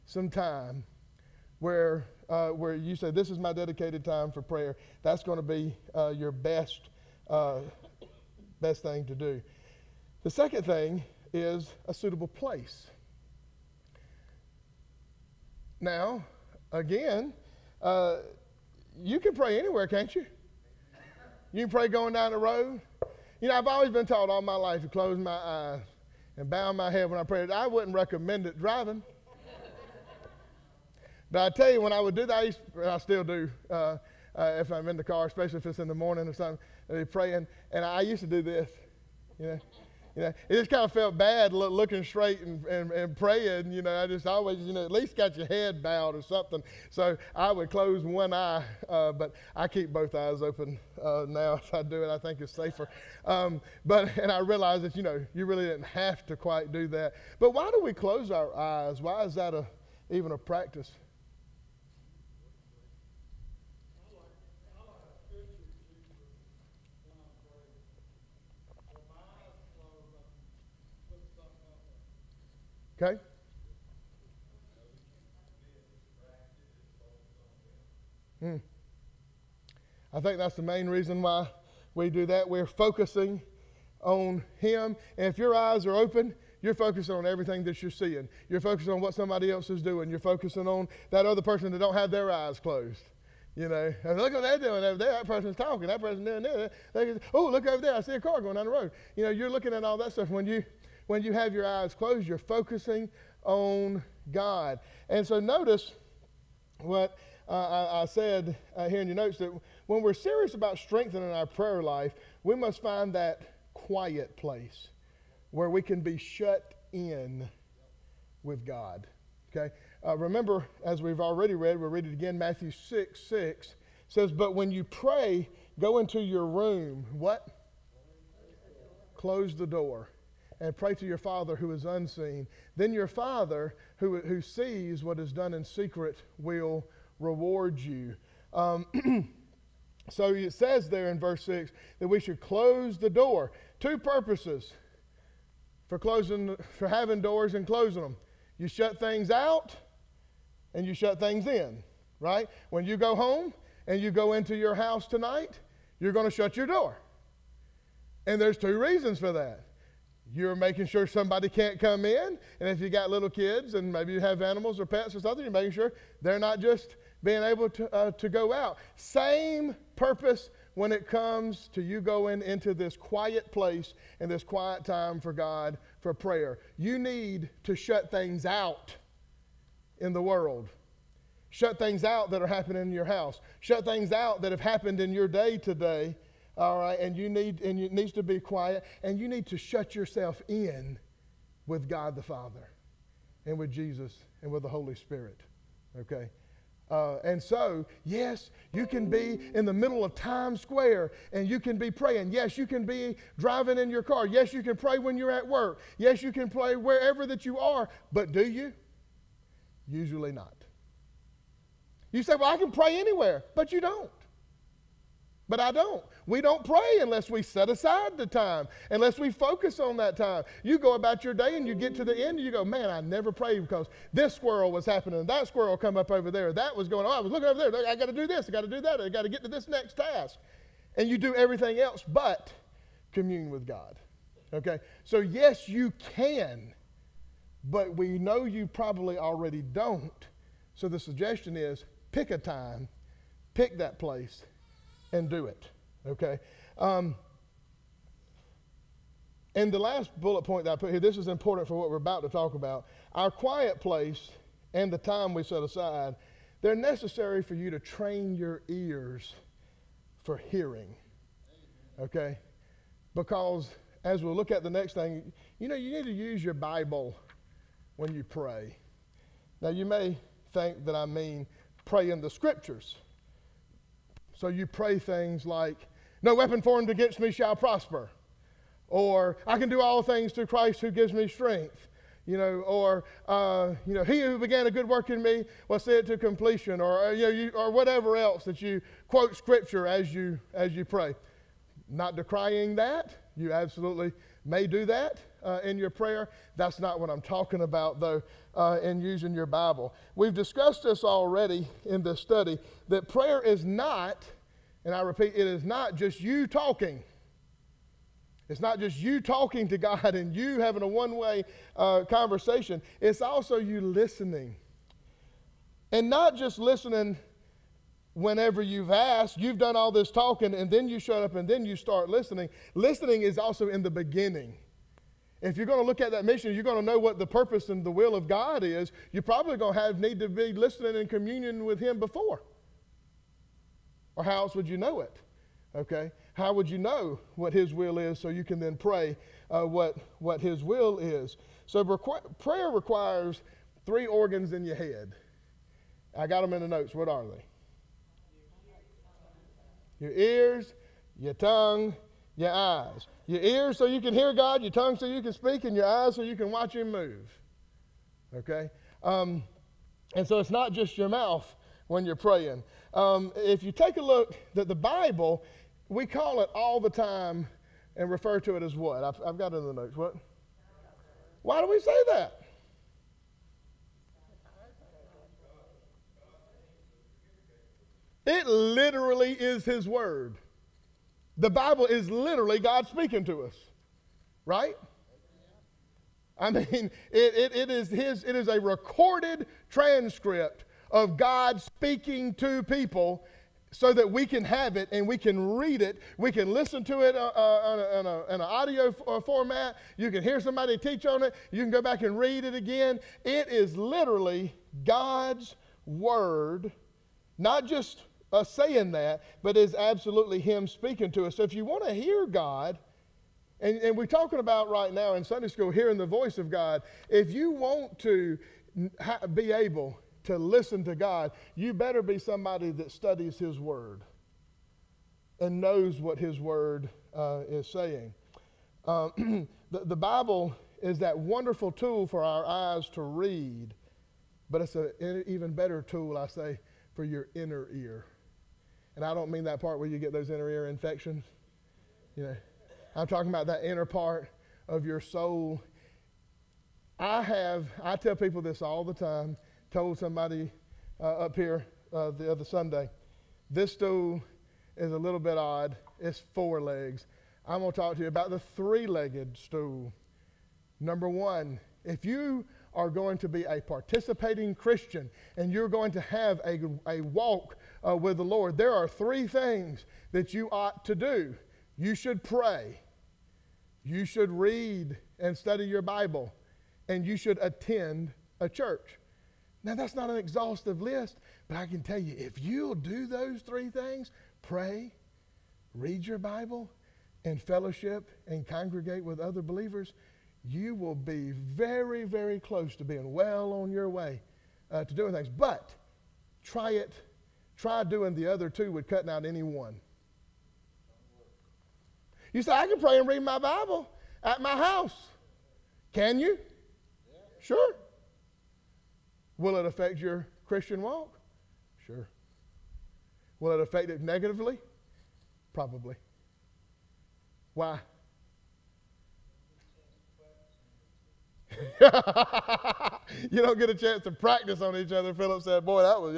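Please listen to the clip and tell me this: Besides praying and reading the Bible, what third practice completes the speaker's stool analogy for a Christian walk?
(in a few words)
Attend a church.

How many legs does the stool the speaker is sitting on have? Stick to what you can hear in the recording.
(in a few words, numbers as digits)
4.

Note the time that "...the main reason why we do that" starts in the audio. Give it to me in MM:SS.
01:20.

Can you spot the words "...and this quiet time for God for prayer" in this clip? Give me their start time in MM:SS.
02:54.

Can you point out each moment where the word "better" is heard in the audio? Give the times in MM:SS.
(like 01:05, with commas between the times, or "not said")
07:01, 07:15.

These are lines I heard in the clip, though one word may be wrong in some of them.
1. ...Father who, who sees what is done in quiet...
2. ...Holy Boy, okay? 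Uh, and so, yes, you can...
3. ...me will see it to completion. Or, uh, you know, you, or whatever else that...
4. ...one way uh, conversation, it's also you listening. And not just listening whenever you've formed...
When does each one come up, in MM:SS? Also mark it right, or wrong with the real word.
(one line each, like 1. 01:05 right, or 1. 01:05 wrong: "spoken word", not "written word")
1. 02:13 wrong: "secret", not "quiet"
2. 03:14 wrong: "Spirit", not "Boy"
3. 04:45 right
4. 05:10 wrong: "asked", not "formed".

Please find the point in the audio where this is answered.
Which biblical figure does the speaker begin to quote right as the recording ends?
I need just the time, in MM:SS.
08:45.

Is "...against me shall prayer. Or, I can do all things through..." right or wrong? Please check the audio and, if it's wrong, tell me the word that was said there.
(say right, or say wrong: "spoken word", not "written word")
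wrong: "prosper", not "prayer".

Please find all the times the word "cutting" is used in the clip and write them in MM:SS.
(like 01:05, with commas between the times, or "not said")
08:18.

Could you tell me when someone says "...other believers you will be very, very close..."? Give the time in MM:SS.
08:09.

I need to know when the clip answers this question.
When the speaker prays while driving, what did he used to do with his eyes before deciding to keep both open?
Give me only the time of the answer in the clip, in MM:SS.
00:47.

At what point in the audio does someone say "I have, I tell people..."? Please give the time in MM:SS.
07:26.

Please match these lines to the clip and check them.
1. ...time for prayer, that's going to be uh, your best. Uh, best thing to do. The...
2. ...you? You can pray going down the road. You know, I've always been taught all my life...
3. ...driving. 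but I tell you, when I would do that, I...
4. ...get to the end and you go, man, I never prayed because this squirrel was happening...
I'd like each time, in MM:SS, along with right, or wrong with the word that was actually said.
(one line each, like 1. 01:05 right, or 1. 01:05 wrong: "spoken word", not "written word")
1. 00:04 right
2. 00:20 right
3. 00:28 right
4. 03:41 right.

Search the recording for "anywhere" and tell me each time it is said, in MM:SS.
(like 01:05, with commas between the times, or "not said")
00:19, 03:32.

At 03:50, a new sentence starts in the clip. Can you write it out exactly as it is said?
And you do everything else but commune with God.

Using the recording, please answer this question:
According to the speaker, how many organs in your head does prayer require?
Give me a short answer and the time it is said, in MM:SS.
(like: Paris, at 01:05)
3, at 05:43.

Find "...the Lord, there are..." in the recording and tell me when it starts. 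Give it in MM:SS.
07:48.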